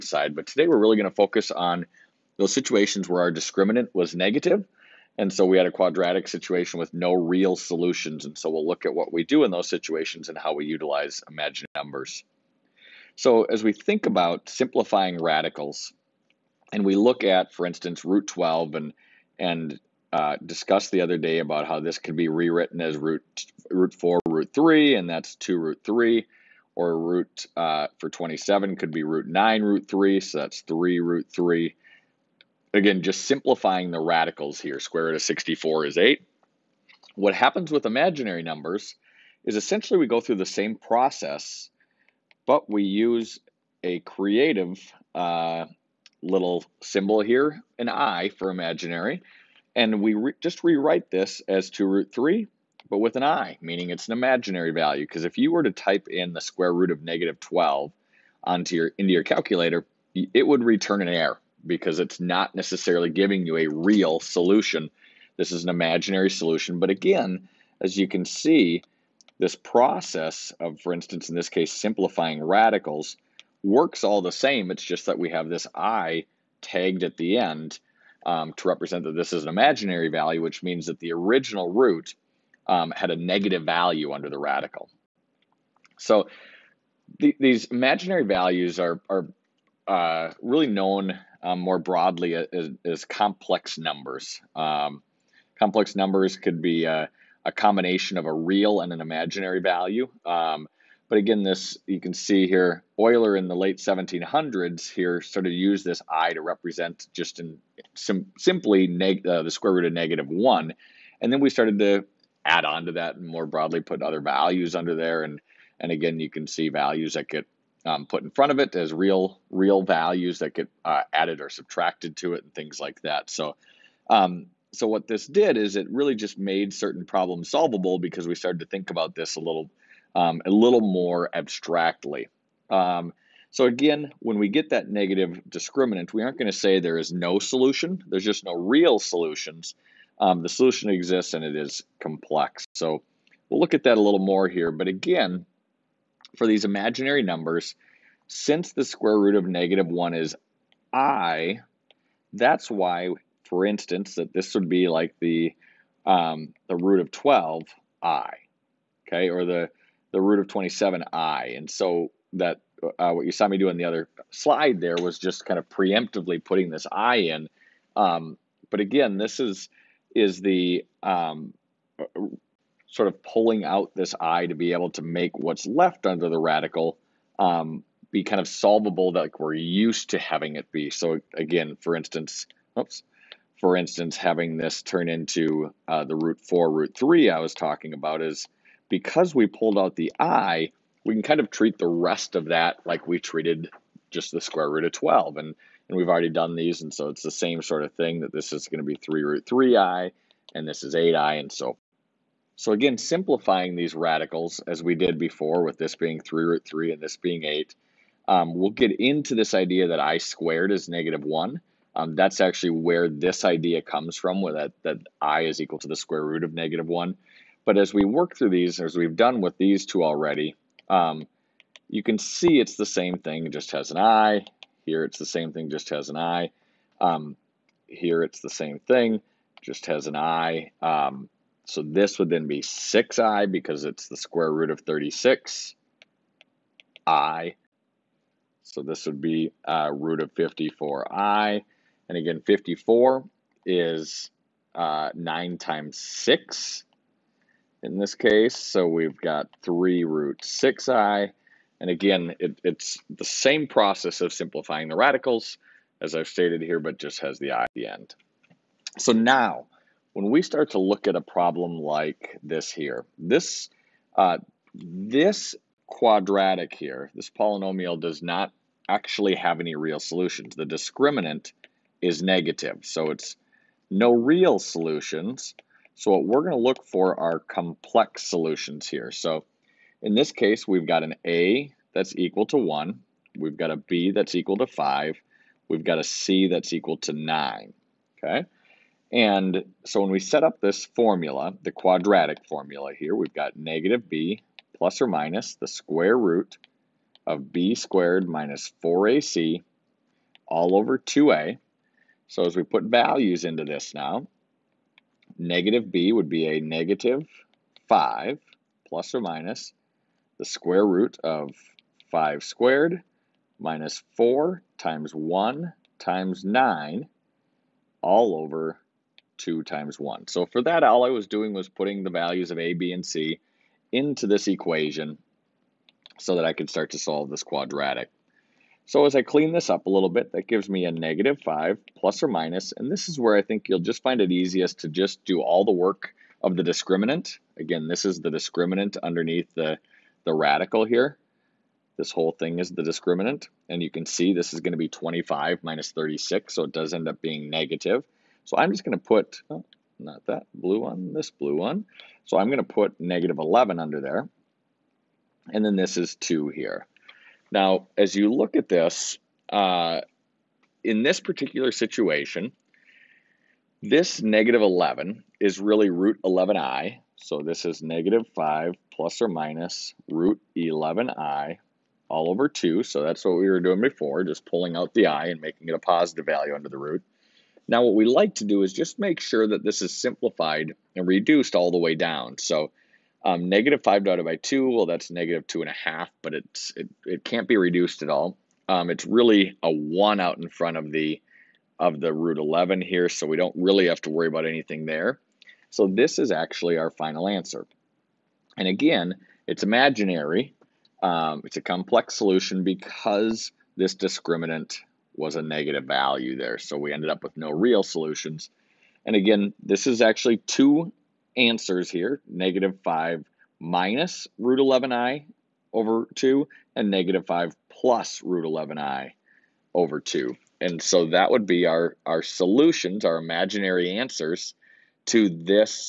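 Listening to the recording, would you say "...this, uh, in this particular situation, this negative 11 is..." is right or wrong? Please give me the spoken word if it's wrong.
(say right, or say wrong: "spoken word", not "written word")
right.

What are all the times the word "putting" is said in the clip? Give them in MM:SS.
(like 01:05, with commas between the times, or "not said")
02:46, 05:21.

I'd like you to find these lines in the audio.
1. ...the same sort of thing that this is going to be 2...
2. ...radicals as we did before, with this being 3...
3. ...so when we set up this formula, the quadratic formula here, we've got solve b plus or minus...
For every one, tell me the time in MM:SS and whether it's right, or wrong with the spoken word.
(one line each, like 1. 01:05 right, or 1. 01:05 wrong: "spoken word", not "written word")
1. 03:17 wrong: "3", not "2"
2. 03:23 right
3. 04:49 wrong: "negative", not "solve".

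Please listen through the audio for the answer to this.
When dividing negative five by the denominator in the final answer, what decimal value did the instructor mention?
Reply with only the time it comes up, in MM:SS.
06:25.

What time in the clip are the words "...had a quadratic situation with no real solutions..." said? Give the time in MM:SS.
00:05.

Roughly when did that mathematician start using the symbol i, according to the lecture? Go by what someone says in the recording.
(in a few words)
late 1700s.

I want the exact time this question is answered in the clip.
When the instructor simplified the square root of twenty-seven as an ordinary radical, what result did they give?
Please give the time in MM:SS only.
00:30.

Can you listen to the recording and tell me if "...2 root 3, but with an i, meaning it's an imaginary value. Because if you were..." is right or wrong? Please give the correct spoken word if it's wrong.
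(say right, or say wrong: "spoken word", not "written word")
right.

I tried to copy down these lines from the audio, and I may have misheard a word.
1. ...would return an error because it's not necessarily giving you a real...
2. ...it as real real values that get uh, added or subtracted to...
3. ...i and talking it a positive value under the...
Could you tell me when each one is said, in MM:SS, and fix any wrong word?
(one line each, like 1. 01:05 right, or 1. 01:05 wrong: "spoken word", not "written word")
1. 01:00 right
2. 01:58 right
3. 06:15 wrong: "making", not "talking".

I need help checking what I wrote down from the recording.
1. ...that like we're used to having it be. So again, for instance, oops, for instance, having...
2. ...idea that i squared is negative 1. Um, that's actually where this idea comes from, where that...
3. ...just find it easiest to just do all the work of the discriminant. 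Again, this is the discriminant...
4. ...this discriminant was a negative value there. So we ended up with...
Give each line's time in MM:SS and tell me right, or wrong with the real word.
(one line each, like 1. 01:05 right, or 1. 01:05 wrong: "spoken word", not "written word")
1. 02:59 right
2. 03:29 right
3. 05:33 right
4. 06:43 right.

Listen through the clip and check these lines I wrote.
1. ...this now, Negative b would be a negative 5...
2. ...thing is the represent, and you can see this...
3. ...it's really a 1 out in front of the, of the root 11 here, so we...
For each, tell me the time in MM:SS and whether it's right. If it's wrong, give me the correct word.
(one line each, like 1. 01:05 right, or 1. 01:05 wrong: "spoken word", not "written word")
1. 05:03 right
2. 05:42 wrong: "discriminant", not "represent"
3. 06:28 right.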